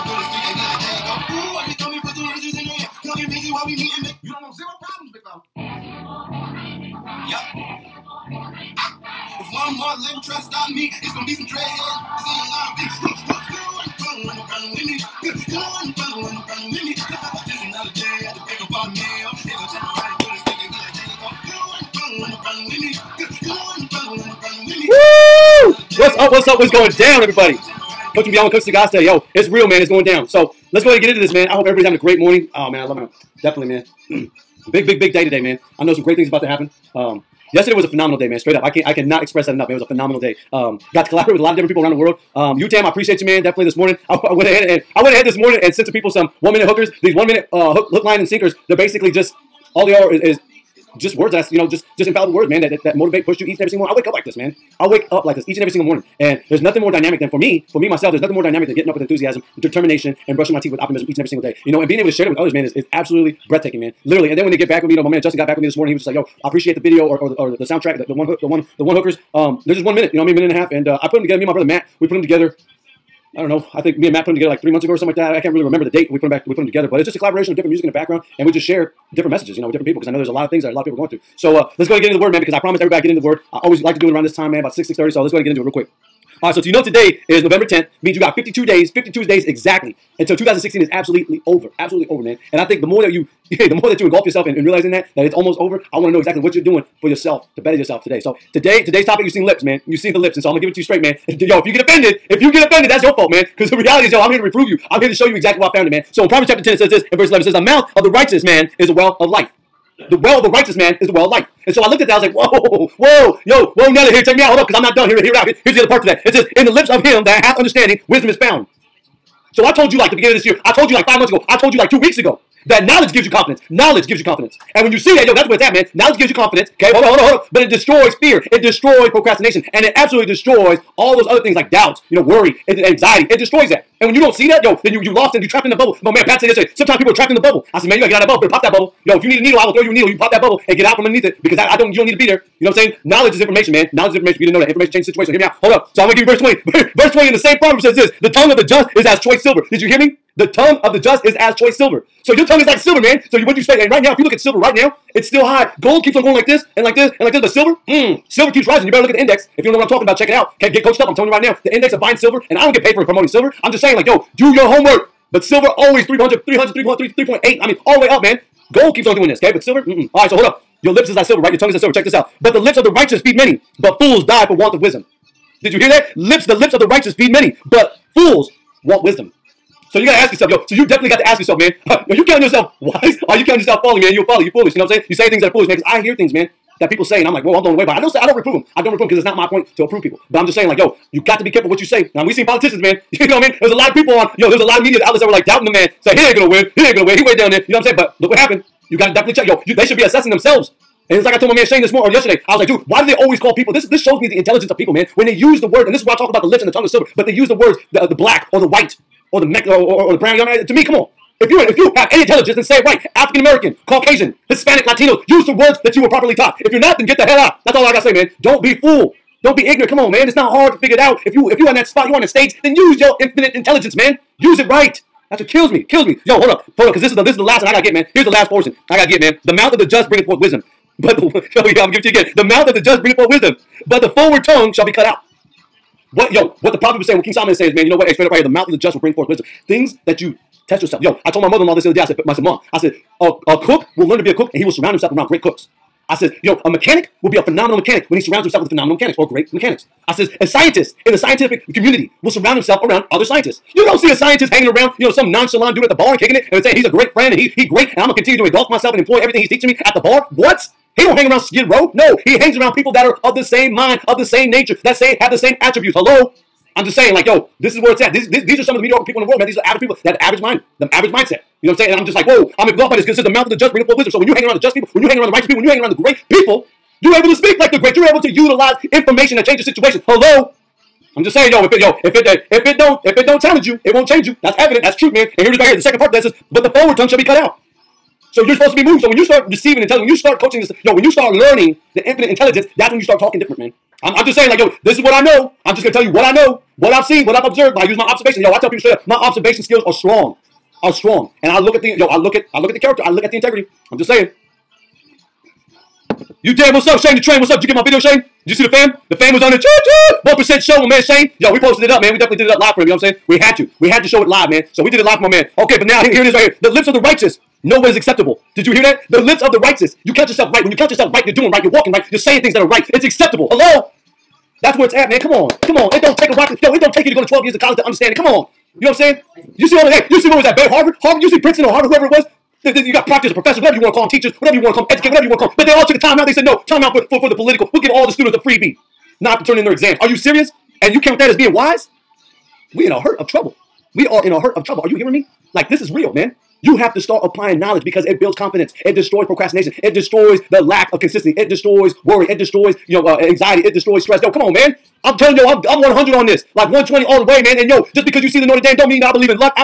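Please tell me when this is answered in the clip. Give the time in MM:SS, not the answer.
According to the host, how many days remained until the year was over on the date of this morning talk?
01:28.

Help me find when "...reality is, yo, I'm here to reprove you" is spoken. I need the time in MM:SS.
01:43.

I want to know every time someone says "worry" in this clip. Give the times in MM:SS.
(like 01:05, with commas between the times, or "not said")
02:12, 05:52.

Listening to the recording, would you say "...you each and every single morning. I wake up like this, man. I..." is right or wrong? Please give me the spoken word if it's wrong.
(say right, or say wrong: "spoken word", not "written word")
right.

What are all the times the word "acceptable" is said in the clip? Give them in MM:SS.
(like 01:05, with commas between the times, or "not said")
05:17, 05:23.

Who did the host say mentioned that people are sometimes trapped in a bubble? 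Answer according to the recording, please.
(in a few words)
Pat.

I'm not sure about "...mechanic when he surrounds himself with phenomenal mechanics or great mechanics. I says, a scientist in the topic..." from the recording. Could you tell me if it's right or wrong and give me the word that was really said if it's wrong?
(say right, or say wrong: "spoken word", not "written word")
wrong: "scientific", not "topic".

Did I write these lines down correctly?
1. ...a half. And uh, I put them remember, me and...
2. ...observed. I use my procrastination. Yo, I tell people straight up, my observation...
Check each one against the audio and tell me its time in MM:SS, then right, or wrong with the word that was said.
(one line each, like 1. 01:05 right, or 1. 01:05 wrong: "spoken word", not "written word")
1. 01:10 wrong: "together", not "remember"
2. 04:57 wrong: "observation", not "procrastination".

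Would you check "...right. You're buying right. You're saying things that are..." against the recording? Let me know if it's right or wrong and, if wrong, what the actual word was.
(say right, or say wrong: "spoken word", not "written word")
wrong: "walking", not "buying".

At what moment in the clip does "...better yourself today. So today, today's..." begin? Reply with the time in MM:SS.
01:37.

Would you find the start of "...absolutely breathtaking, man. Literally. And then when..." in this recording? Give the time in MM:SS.
01:02.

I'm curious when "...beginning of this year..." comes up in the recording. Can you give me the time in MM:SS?
02:00.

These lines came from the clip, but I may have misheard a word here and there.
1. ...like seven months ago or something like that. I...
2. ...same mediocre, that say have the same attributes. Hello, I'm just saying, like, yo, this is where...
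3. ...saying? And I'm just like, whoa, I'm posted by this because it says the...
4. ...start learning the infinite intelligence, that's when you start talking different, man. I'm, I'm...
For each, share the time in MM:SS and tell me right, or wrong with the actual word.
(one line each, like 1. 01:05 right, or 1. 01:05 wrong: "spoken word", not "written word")
1. 01:14 wrong: "three", not "seven"
2. 04:24 wrong: "nature", not "mediocre"
3. 04:31 wrong: "engulfed", not "posted"
4. 04:51 right.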